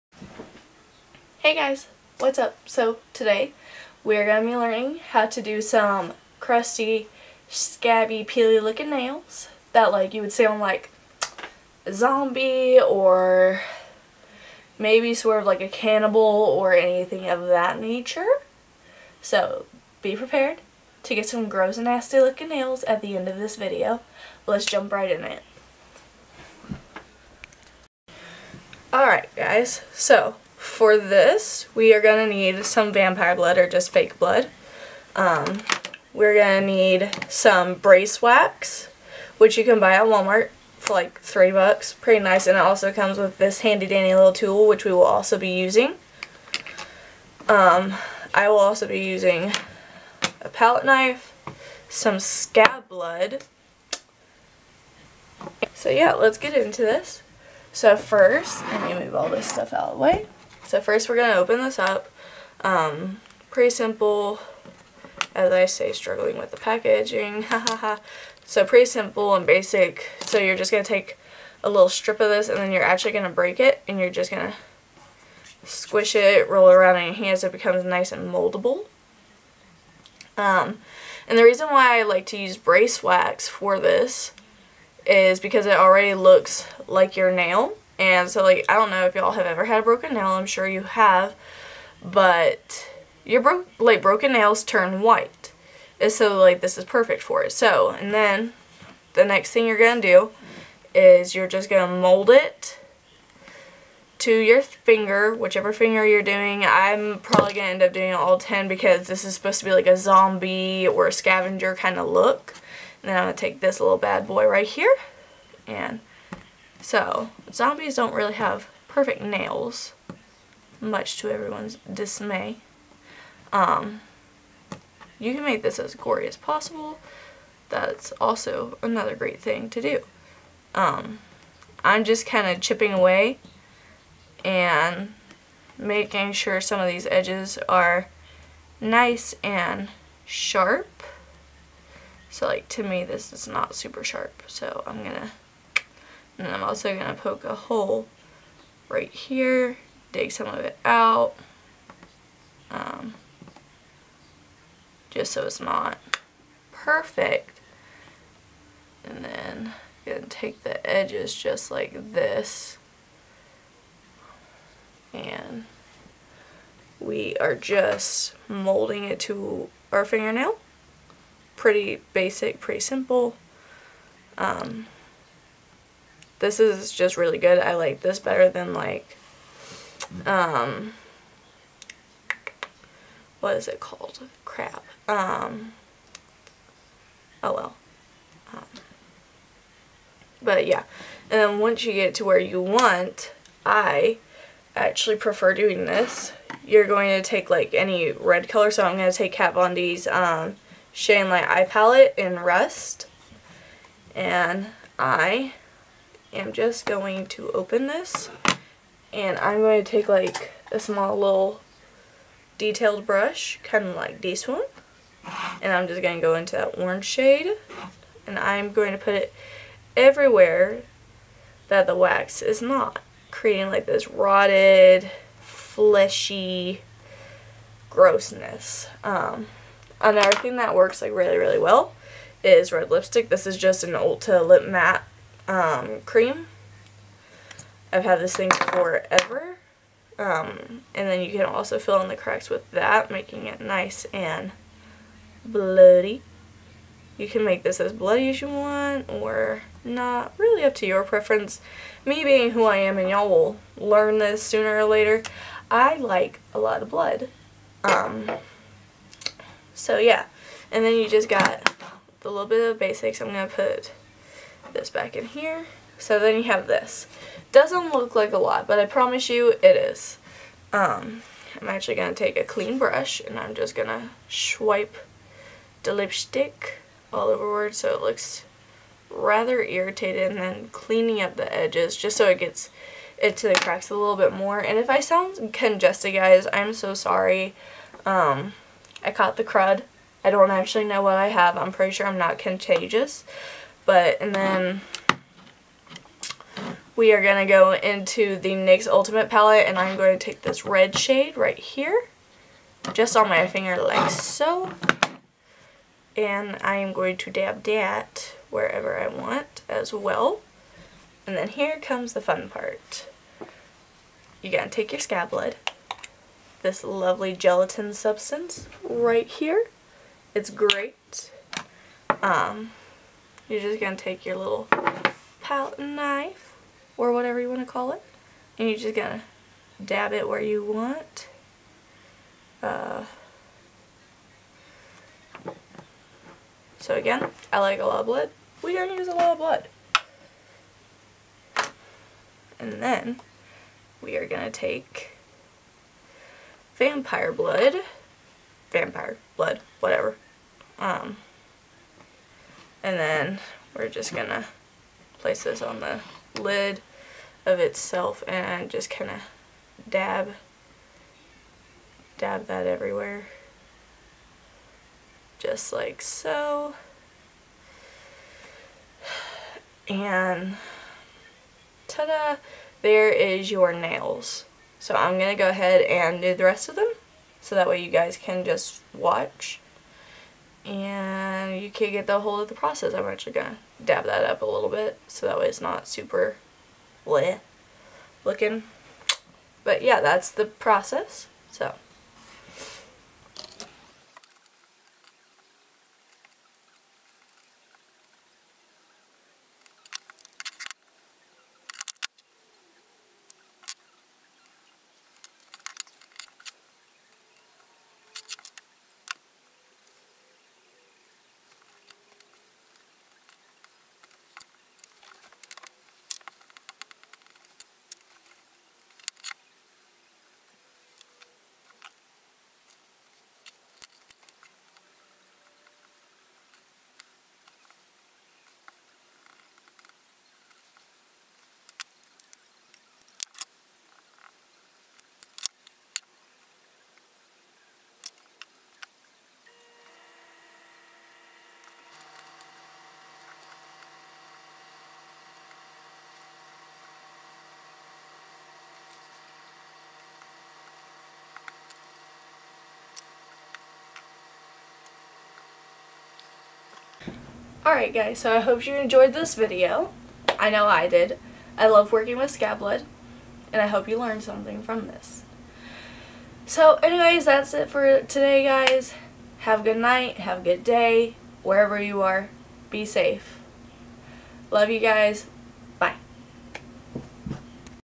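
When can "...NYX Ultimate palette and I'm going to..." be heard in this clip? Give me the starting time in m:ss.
4:58.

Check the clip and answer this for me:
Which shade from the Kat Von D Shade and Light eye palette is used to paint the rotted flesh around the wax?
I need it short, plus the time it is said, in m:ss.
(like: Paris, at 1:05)
Rust, at 3:22.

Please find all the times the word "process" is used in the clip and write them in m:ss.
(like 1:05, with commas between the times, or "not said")
6:22, 6:30.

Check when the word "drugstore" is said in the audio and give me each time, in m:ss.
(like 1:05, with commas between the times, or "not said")
not said.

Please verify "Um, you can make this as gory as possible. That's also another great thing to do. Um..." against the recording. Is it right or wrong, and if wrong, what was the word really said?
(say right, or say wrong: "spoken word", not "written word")
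right.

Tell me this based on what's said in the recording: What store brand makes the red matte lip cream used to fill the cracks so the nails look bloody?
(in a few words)
Ulta.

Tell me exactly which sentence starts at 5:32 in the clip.
Uh, so again, I like a lot of blood.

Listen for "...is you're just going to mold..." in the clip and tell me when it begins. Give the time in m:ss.
1:40.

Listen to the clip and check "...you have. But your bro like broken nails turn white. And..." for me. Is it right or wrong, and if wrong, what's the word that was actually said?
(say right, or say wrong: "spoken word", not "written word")
right.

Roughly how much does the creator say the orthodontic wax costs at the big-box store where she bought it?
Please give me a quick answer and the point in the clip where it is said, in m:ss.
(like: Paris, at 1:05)
3 dollars, at 0:41.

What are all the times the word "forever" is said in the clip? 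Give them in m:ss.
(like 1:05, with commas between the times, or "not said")
3:58.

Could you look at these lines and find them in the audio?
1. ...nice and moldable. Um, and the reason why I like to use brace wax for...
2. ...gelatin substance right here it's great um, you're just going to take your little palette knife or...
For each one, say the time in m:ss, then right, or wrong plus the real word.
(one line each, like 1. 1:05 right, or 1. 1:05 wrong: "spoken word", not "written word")
1. 1:17 right
2. 5:17 right.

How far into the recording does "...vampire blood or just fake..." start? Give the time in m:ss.
0:32.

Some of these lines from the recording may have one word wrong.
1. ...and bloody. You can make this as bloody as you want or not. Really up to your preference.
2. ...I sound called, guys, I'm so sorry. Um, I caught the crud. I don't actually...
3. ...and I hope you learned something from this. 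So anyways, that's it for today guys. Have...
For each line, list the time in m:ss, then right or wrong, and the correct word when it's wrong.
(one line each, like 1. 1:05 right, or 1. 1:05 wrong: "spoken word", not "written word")
1. 4:04 right
2. 4:44 wrong: "congested", not "called"
3. 7:43 right.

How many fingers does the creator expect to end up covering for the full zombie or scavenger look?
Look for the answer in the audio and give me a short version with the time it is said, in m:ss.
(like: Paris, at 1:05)
10, at 1:48.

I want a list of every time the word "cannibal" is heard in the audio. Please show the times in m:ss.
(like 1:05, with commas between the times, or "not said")
0:15.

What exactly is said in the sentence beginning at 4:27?
Doesn't look like a lot, but I promise you it is.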